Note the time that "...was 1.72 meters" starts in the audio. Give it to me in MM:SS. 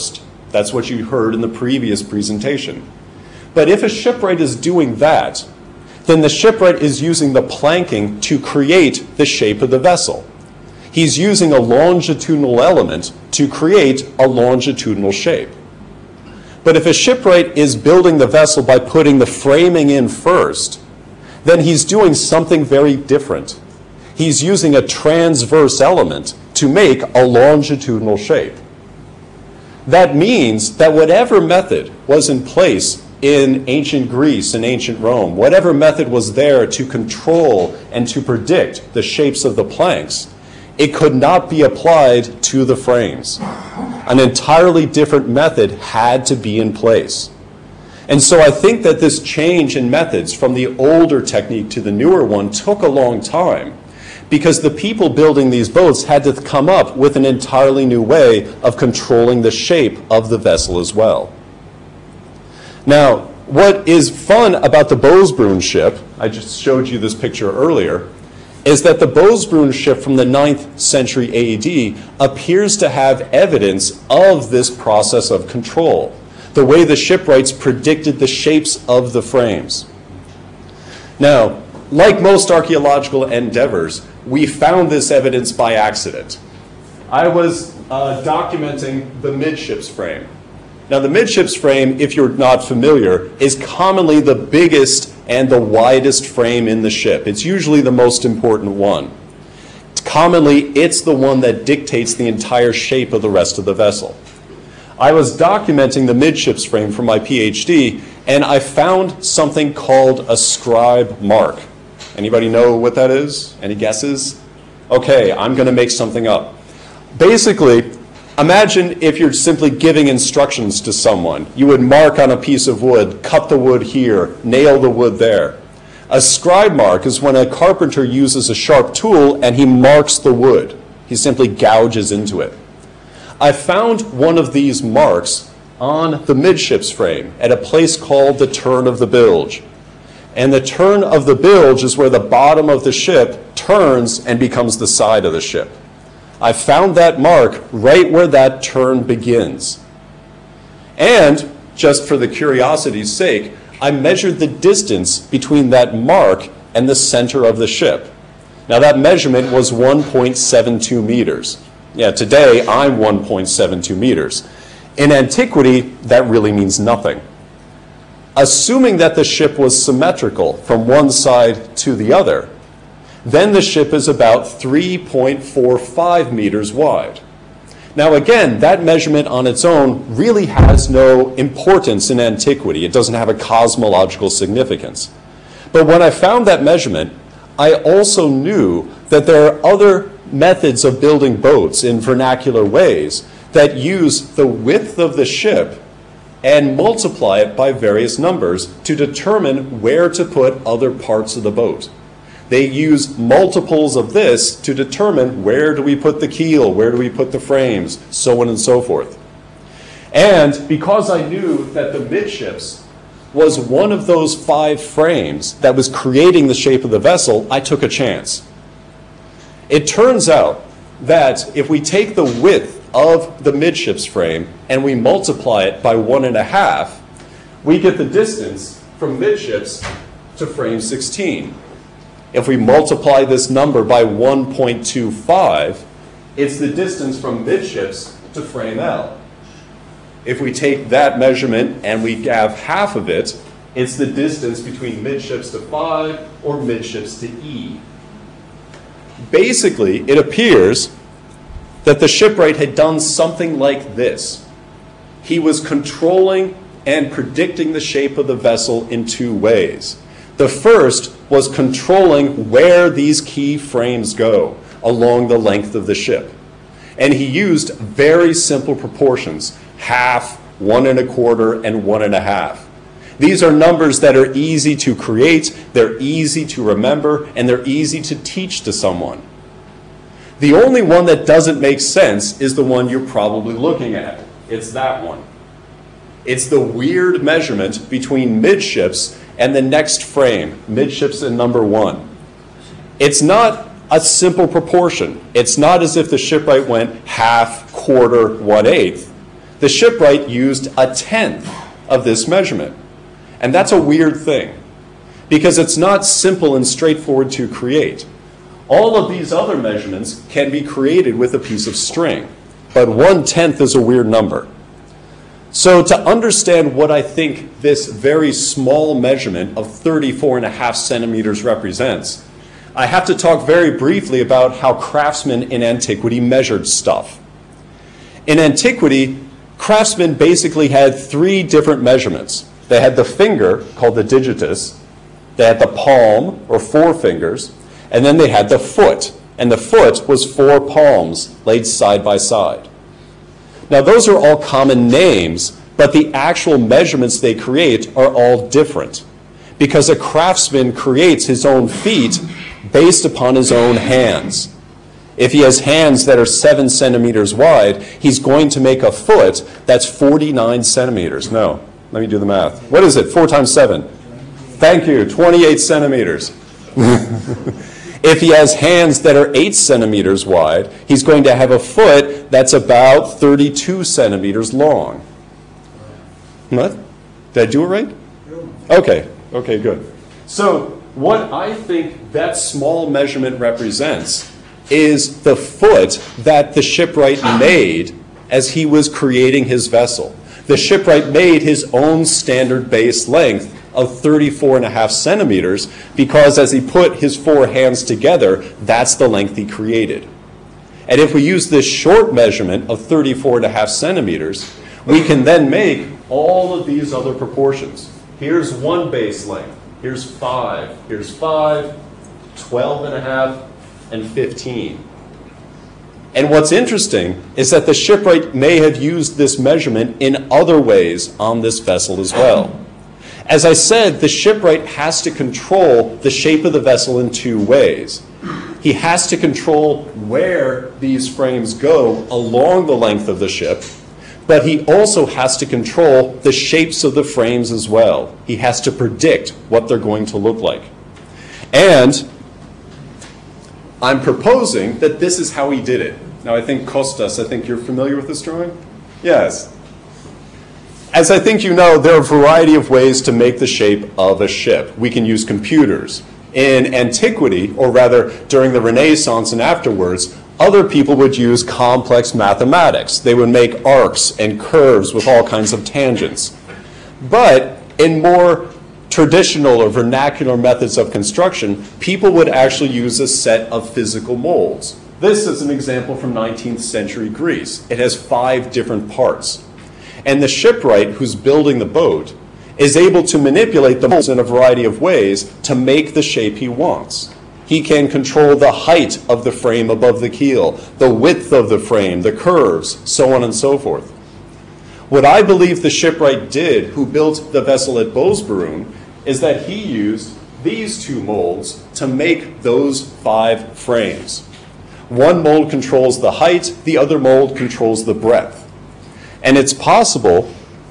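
02:39.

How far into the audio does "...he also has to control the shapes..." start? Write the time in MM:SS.
07:14.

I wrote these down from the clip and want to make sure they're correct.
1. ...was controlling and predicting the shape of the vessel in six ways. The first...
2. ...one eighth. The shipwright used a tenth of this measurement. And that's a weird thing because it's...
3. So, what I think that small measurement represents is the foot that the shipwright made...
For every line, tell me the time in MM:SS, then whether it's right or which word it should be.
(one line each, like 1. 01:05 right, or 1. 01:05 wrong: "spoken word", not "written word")
1. 04:15 wrong: "two", not "six"
2. 04:58 right
3. 06:20 right.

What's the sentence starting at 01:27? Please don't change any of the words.
I was uh, documenting the midships frame.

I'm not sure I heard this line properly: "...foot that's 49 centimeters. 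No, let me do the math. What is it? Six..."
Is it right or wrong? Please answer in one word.
wrong.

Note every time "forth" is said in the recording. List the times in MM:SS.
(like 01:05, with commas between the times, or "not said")
03:28, 08:13.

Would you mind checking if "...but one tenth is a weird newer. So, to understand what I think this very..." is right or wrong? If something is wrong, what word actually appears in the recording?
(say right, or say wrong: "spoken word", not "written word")
wrong: "number", not "newer".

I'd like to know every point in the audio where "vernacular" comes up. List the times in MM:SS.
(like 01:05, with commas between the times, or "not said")
03:12, 07:49.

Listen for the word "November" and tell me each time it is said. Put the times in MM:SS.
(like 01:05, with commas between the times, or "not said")
not said.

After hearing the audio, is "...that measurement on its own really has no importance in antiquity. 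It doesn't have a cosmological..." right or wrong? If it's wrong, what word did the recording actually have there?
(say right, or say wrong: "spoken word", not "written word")
right.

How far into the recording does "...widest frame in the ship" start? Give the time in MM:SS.
01:35.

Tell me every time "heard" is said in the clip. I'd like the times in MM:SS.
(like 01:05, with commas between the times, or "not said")
00:01.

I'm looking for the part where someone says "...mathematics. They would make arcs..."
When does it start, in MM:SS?
07:42.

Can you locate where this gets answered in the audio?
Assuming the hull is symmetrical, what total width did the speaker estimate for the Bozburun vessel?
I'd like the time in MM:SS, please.
02:54.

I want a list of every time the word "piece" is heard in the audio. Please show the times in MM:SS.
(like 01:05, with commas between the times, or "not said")
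02:02, 05:11.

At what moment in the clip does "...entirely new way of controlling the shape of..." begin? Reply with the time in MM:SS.
00:57.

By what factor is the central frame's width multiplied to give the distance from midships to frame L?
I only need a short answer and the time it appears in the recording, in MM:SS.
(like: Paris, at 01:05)
1.25, at 03:54.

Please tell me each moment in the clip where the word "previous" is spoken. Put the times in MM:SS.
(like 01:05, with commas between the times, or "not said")
00:01.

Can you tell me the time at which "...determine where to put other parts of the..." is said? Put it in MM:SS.
03:18.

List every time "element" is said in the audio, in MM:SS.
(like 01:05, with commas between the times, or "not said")
00:12, 00:25.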